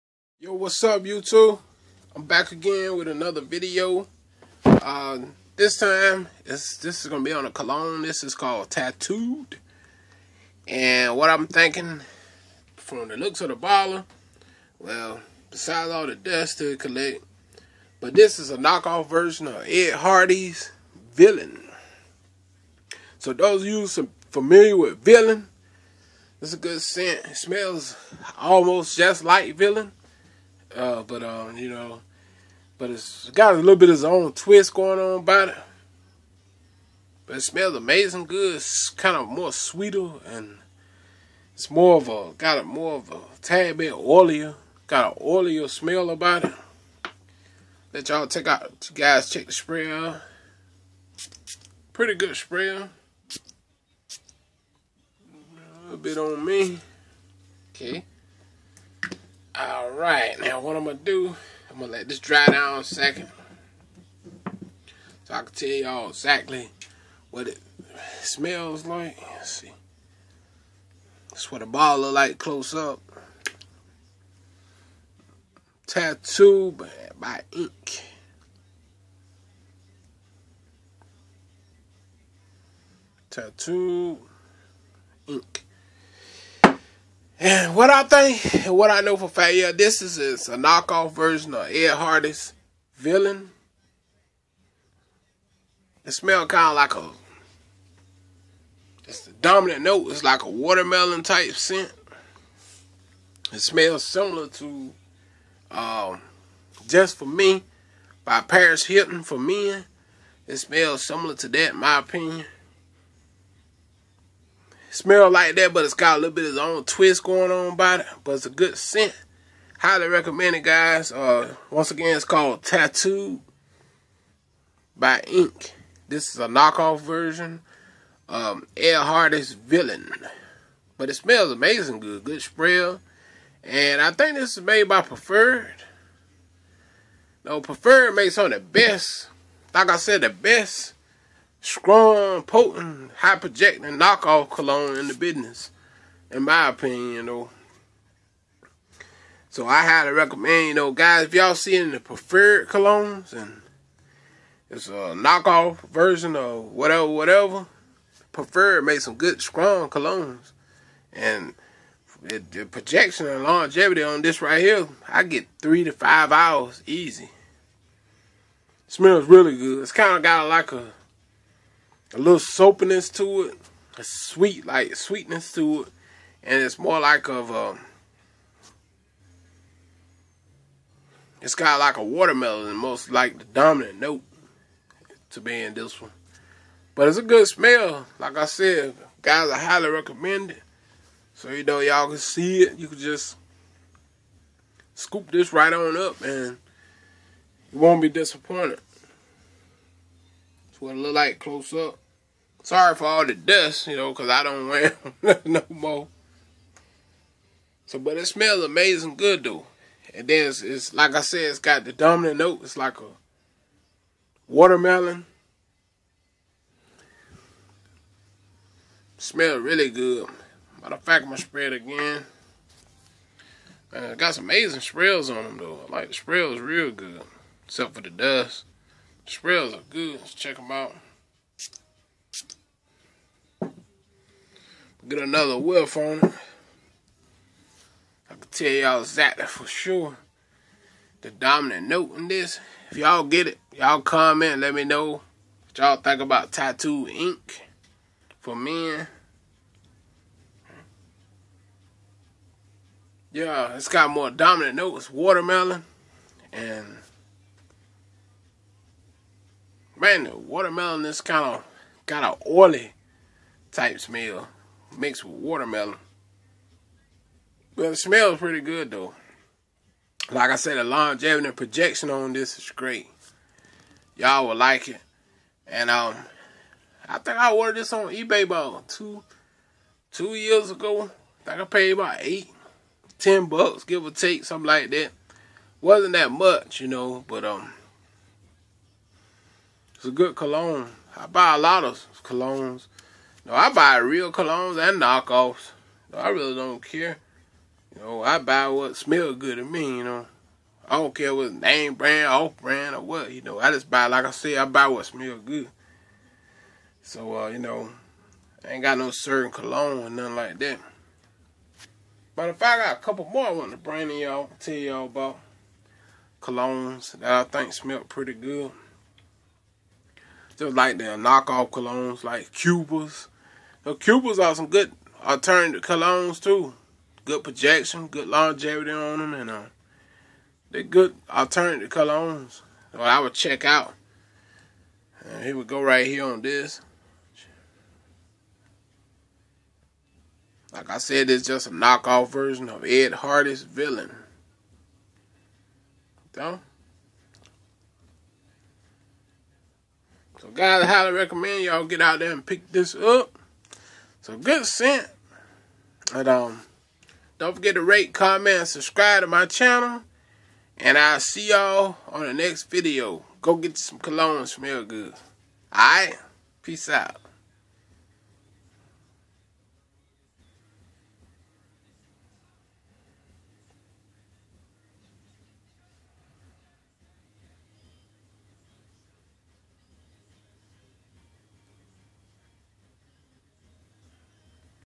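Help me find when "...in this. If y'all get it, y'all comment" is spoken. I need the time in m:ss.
4:02.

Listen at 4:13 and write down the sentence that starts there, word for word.
Yeah, it's got more dominant notes, watermelon, and man, the watermelon is kind of got an oily type smell mixed with watermelon.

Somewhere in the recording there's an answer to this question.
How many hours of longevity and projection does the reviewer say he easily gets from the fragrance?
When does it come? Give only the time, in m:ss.
2:45.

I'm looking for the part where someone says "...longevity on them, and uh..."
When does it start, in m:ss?
5:28.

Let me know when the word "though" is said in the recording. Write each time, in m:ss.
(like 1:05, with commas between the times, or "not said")
2:27, 3:29, 3:45, 4:28.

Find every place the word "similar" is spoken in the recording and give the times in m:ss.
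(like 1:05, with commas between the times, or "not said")
1:44, 1:51.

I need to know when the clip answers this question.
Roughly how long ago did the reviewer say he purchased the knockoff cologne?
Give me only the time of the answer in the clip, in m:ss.
4:38.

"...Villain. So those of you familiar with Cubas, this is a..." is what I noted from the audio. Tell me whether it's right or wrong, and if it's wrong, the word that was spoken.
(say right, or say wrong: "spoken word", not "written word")
wrong: "Villain", not "Cubas".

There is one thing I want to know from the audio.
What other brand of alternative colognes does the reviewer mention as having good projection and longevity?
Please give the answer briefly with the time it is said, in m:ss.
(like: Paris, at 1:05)
Cuba, at 5:22.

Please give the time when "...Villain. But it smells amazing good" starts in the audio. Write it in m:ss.
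2:09.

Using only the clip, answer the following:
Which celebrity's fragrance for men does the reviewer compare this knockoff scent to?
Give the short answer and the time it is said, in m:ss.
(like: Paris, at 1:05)
Paris Hilton, at 1:48.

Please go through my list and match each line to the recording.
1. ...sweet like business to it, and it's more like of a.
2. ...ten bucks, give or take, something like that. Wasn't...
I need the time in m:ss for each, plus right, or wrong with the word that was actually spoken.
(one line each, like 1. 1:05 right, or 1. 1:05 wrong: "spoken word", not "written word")
1. 2:54 wrong: "sweetness", not "business"
2. 4:43 right.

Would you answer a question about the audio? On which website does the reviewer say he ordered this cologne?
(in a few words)
eBay.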